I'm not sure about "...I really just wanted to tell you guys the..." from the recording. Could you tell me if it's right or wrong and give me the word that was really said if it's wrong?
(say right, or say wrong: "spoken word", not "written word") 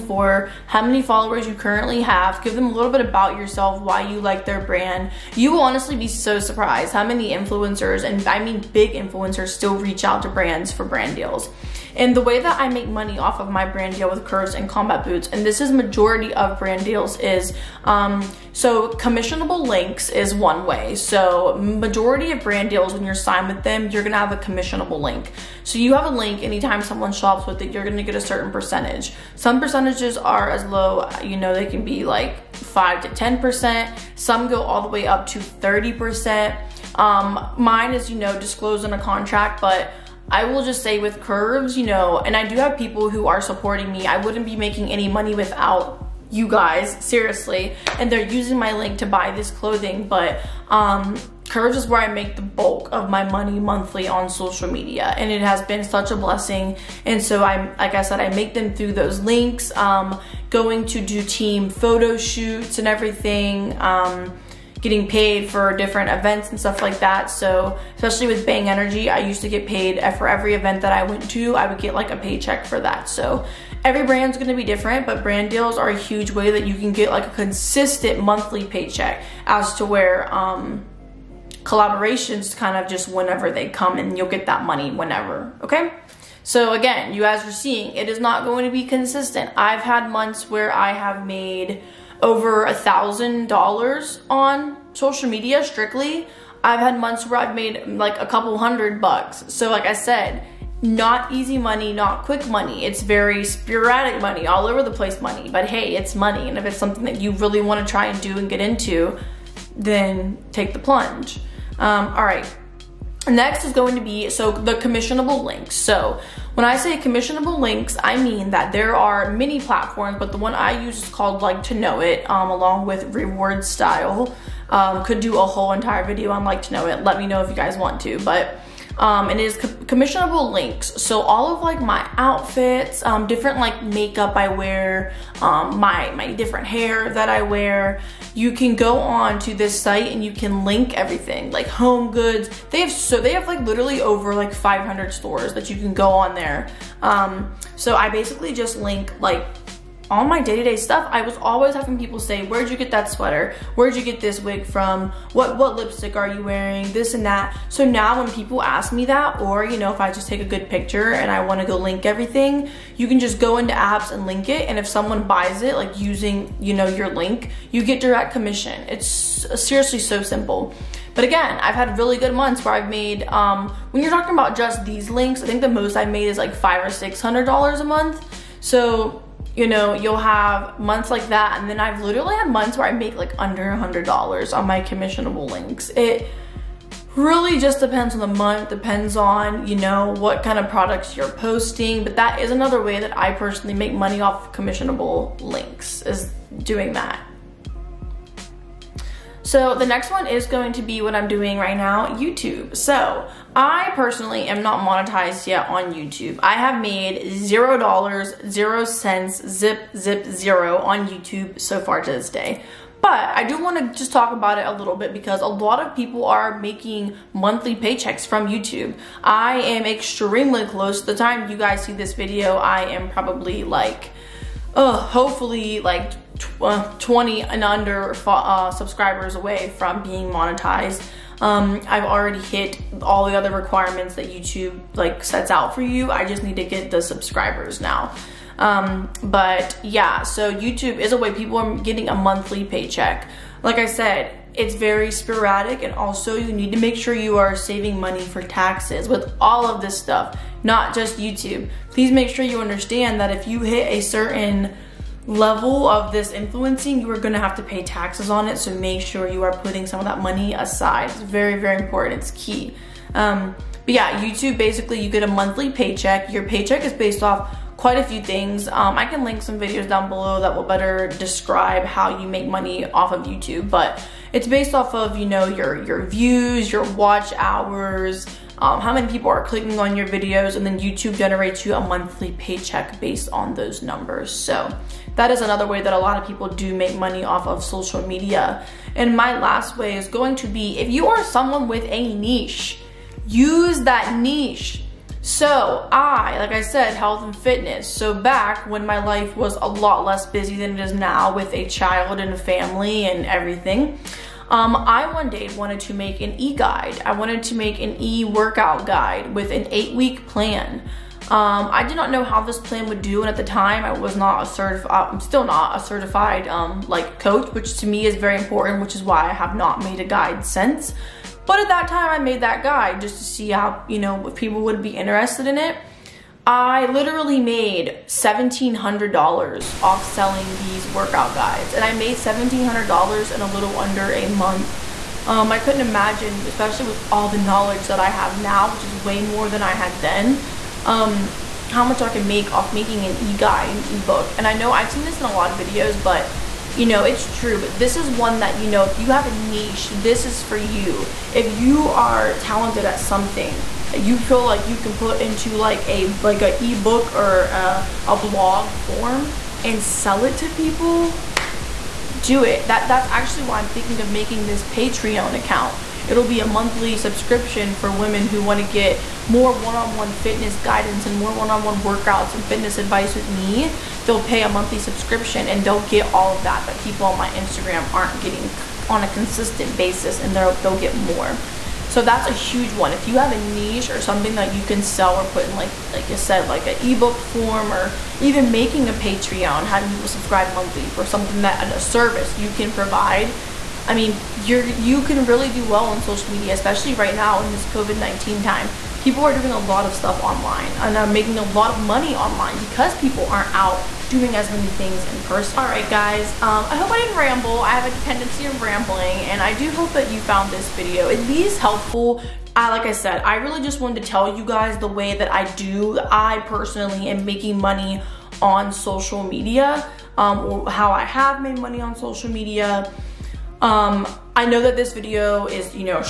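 right.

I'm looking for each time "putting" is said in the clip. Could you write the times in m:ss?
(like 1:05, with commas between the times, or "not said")
4:19.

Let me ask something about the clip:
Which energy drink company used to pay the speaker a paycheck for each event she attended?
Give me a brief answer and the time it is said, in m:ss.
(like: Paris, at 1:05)
Bang Energy, at 1:08.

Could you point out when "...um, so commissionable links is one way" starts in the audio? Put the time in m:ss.
0:17.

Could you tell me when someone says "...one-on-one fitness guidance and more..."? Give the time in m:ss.
6:09.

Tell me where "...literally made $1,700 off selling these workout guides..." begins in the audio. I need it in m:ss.
5:26.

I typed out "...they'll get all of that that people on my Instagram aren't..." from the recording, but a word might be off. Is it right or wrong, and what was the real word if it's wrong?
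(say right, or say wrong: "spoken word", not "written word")
right.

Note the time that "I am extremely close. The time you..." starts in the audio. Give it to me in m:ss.
3:39.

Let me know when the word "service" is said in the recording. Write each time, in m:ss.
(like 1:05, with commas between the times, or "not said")
6:31.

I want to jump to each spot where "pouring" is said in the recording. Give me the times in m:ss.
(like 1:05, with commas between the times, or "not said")
not said.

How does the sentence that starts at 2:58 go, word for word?
So you know, you'll have months like that.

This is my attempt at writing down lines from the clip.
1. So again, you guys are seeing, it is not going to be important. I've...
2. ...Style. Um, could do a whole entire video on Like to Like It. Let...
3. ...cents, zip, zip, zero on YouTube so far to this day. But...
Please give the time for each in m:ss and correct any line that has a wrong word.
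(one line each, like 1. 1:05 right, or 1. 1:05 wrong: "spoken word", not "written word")
1. 1:26 wrong: "consistent", not "important"
2. 2:03 wrong: "Know", not "Like"
3. 3:28 right.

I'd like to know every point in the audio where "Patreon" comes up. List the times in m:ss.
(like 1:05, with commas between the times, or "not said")
6:04, 6:28.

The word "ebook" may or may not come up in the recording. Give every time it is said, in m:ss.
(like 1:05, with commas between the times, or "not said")
5:56, 6:26.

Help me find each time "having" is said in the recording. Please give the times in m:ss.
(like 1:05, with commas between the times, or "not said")
2:31, 6:29.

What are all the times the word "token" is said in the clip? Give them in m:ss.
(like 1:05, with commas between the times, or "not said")
not said.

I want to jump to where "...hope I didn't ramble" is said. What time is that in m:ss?
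6:46.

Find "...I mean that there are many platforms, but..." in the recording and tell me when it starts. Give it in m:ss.
1:58.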